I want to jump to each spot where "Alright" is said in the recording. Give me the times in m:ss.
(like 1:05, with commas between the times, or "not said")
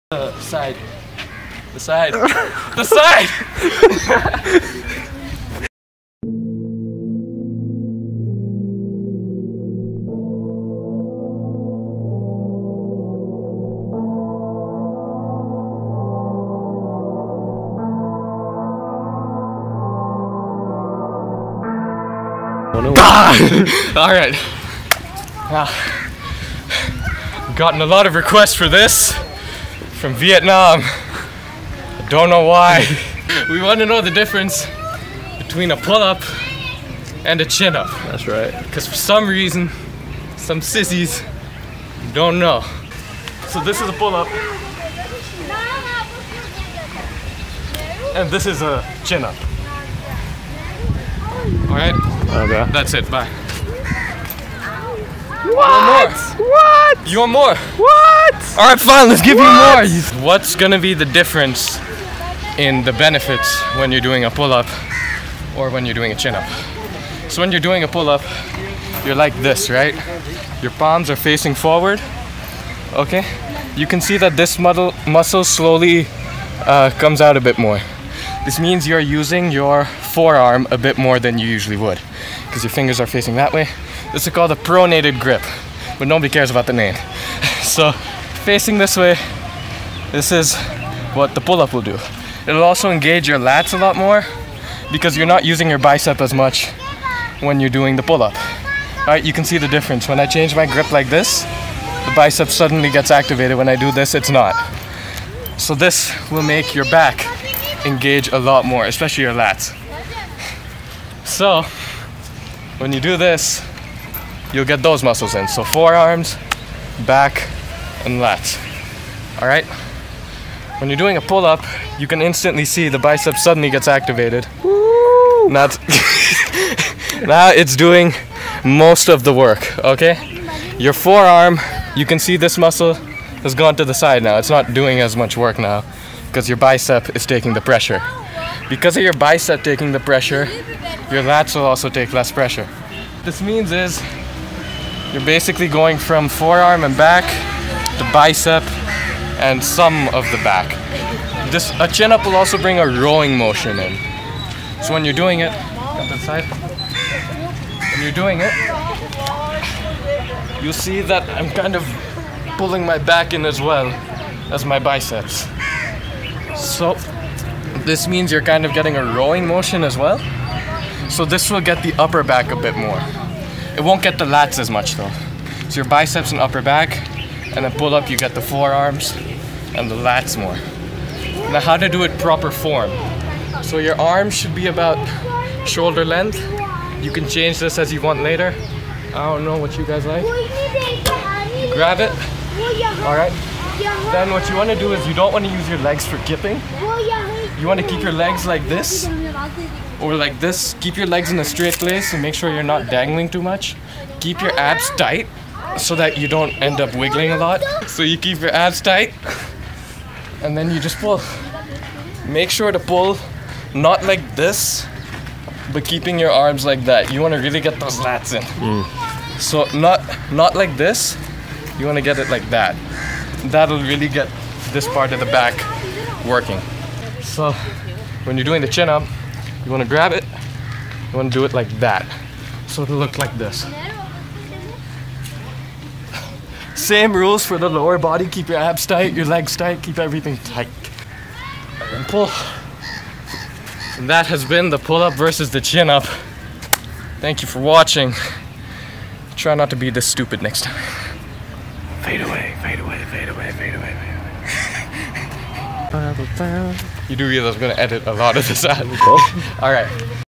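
0:51, 4:19.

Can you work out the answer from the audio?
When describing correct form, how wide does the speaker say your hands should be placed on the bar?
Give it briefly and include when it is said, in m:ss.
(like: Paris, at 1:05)
shoulder length, at 3:05.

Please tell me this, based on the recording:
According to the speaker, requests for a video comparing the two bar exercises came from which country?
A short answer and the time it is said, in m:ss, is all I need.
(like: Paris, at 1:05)
Vietnam, at 0:30.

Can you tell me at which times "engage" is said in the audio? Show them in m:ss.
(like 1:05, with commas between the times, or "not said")
1:32, 1:47.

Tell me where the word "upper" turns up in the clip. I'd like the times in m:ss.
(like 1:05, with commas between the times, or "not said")
2:51, 2:56.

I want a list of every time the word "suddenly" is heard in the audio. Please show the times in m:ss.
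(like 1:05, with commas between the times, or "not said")
1:42, 2:03.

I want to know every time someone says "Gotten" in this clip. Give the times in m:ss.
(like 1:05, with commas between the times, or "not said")
0:27.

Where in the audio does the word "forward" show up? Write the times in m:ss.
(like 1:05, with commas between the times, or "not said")
1:11.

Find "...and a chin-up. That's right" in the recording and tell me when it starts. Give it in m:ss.
0:37.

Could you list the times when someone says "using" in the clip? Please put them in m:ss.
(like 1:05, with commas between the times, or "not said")
1:18, 1:35.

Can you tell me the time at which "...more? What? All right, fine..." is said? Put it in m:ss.
0:57.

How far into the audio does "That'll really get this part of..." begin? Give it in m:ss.
3:43.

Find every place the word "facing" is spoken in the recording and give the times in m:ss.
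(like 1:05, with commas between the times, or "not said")
1:11, 1:23, 1:28.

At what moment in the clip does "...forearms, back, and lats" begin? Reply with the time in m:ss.
1:55.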